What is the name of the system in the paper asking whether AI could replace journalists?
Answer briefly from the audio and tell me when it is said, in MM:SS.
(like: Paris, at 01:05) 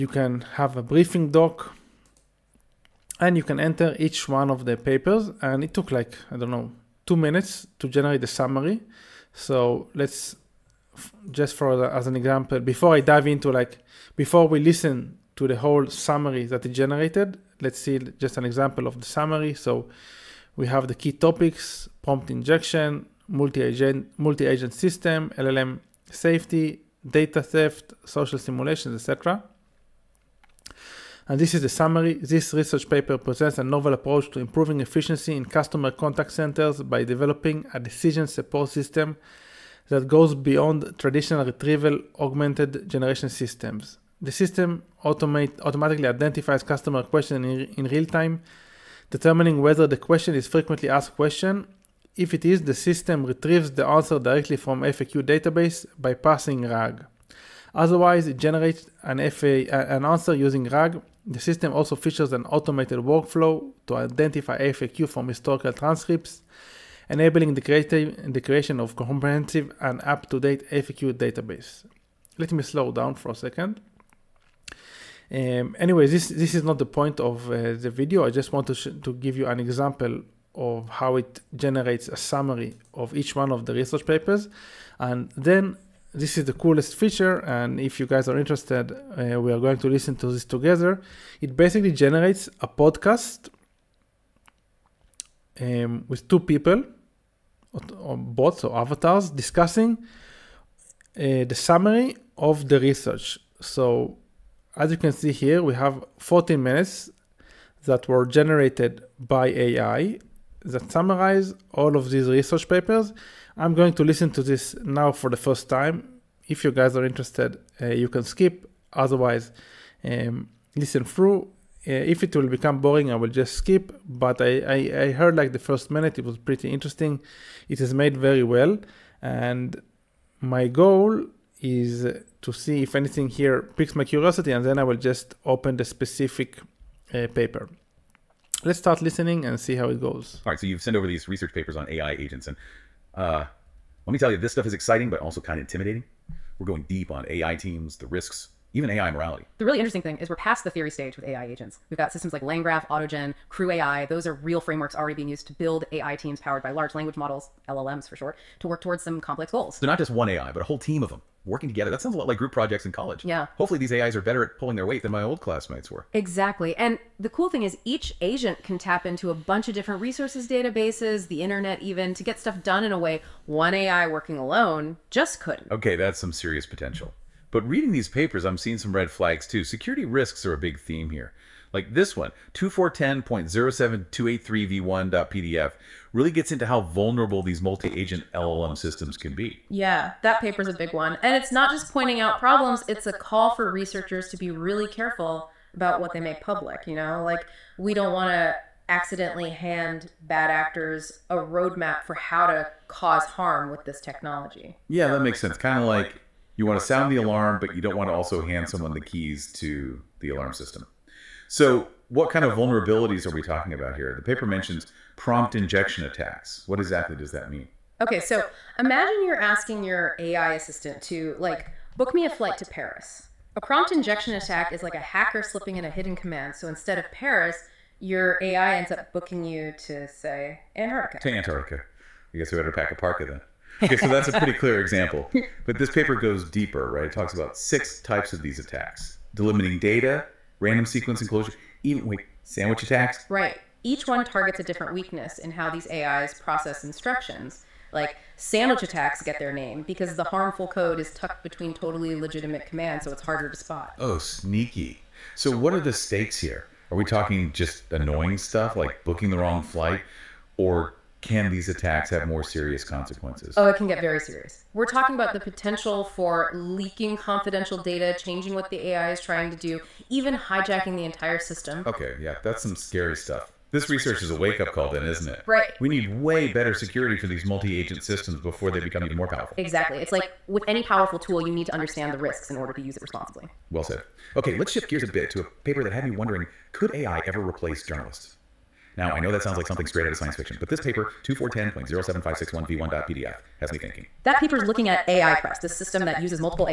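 AI Press, at 04:55.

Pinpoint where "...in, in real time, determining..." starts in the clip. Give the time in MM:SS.
00:47.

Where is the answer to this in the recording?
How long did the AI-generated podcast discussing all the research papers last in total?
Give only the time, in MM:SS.
01:46.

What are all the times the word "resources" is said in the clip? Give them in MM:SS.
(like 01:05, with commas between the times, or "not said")
02:50.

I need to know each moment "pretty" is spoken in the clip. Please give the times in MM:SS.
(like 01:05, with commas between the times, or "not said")
02:06, 03:54.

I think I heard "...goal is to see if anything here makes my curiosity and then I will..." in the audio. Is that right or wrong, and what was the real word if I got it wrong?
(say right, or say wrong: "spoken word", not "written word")
wrong: "piques", not "makes".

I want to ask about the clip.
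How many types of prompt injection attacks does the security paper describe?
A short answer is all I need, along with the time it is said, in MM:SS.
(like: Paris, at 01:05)
6, at 03:57.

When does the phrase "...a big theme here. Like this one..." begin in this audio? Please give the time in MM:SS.
03:00.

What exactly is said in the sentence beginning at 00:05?
And it took like, I don't know, two minutes to generate the summary.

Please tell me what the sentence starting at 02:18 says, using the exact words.
Let's start listening and see how it goes.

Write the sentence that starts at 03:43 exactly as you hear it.
A prompt injection attack is like a hacker slipping in a hidden command.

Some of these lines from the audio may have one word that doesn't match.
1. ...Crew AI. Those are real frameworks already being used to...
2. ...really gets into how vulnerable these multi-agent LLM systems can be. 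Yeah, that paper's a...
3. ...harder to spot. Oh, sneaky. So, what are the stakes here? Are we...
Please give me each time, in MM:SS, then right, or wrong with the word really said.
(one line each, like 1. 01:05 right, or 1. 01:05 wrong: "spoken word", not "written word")
1. 02:33 right
2. 03:06 right
3. 04:13 right.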